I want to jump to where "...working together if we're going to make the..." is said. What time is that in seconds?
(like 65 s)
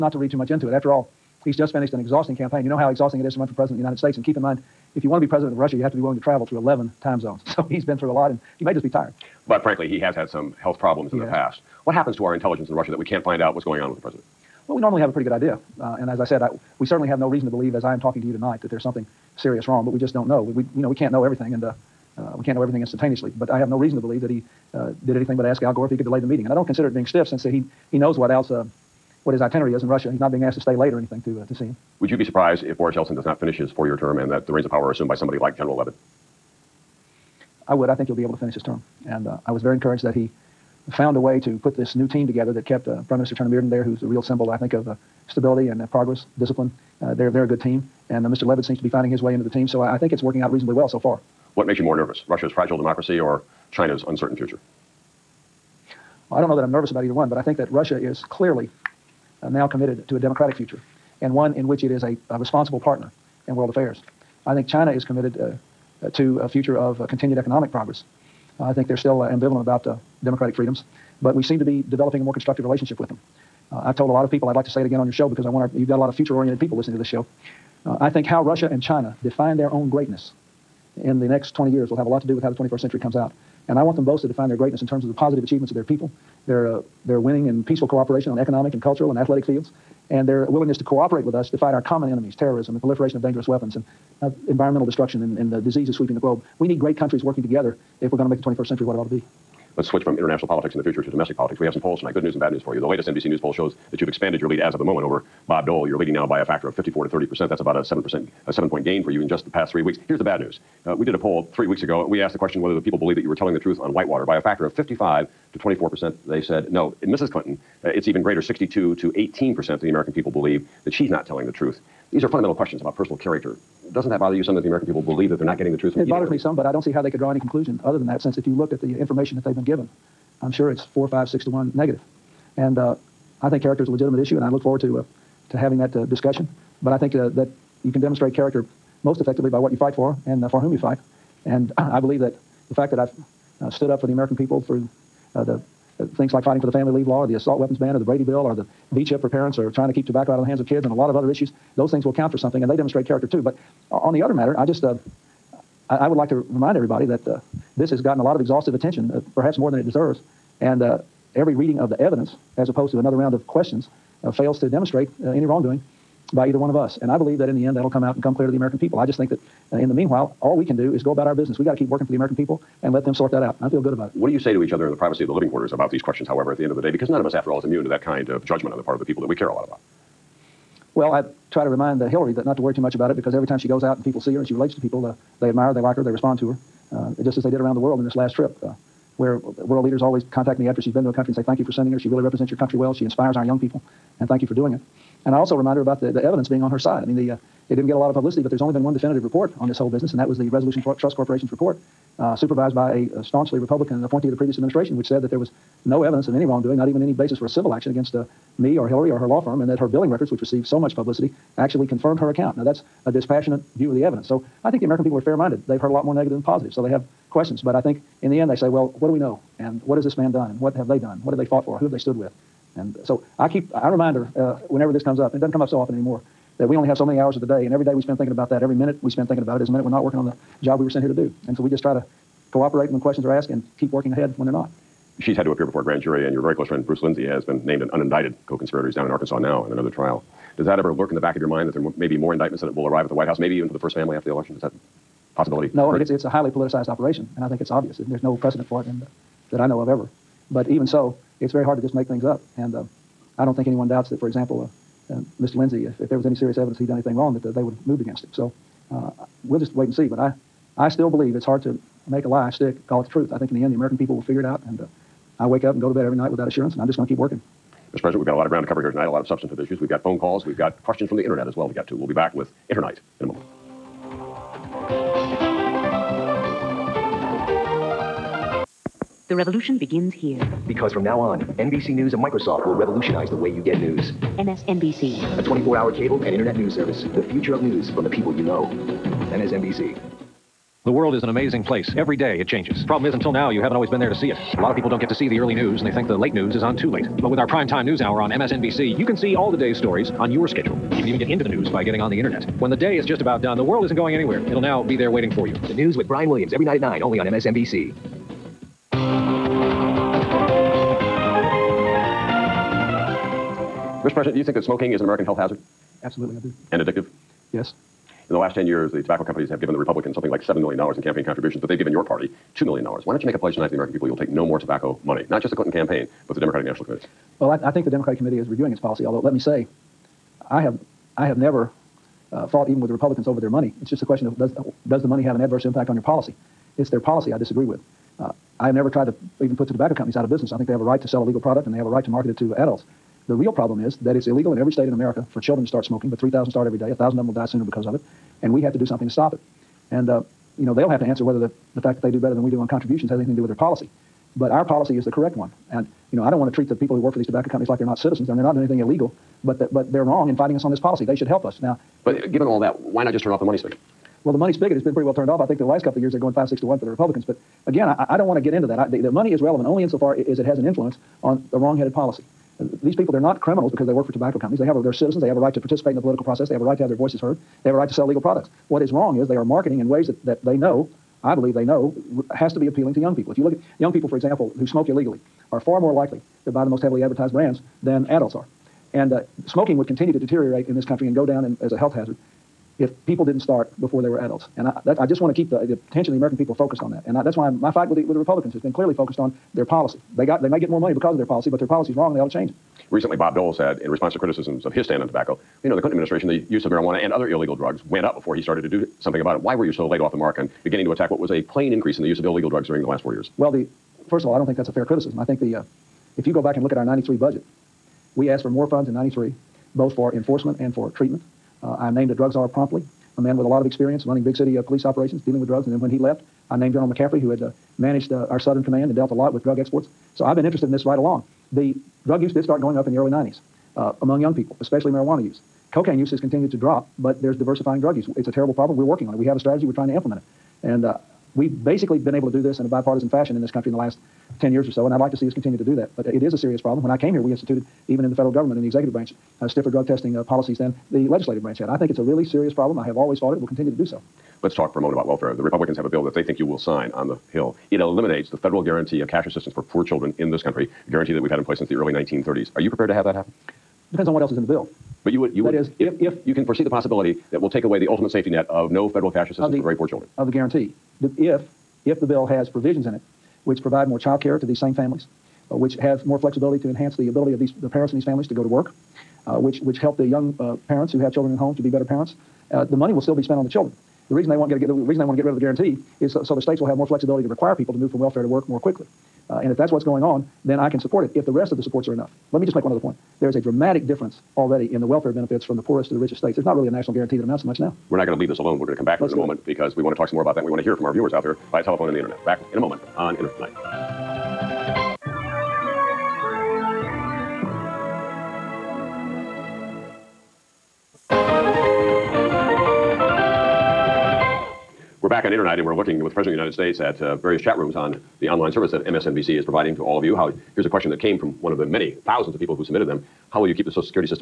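97 s.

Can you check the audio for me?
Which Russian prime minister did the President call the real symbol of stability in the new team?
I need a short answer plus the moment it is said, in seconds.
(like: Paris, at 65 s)
Chernomyrdin, at 43 s.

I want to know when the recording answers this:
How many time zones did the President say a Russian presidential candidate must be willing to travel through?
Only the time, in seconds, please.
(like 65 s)
6 s.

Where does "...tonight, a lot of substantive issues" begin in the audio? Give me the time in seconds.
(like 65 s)
268 s.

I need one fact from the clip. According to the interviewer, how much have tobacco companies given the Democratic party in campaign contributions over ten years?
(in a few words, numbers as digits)
$2 million.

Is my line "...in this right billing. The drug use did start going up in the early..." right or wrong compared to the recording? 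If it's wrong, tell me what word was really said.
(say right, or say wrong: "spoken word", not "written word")
wrong: "along", not "billing".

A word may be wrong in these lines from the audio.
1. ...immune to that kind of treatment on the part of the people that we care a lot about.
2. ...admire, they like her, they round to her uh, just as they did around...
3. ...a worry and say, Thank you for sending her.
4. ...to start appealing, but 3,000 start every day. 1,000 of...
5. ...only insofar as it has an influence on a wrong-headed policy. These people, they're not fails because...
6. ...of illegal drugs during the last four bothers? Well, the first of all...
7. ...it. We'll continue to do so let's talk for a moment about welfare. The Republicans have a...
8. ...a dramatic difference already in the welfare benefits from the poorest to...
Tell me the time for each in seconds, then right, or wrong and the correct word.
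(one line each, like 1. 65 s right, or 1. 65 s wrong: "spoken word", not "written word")
1. 177 s wrong: "judgment", not "treatment"
2. 185 s wrong: "respond", not "round"
3. 191 s wrong: "country", not "worry"
4. 345 s wrong: "smoking", not "appealing"
5. 369 s wrong: "criminals", not "fails"
6. 412 s wrong: "years", not "bothers"
7. 453 s right
8. 493 s right.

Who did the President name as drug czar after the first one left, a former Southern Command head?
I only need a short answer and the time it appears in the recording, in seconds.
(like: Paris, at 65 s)
General McCaffrey, at 426 s.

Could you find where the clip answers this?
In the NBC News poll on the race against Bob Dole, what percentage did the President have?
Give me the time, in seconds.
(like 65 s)
106 s.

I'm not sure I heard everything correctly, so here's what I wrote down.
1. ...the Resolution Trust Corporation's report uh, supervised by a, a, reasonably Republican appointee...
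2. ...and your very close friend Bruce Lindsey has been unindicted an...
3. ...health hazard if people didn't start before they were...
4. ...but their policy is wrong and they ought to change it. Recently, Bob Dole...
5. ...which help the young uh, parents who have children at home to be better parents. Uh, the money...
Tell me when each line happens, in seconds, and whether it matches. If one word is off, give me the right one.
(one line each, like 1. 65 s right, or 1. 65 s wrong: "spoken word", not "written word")
1. 200 s wrong: "staunchly", not "reasonably"
2. 236 s wrong: "named", not "unindicted"
3. 391 s right
4. 401 s right
5. 479 s right.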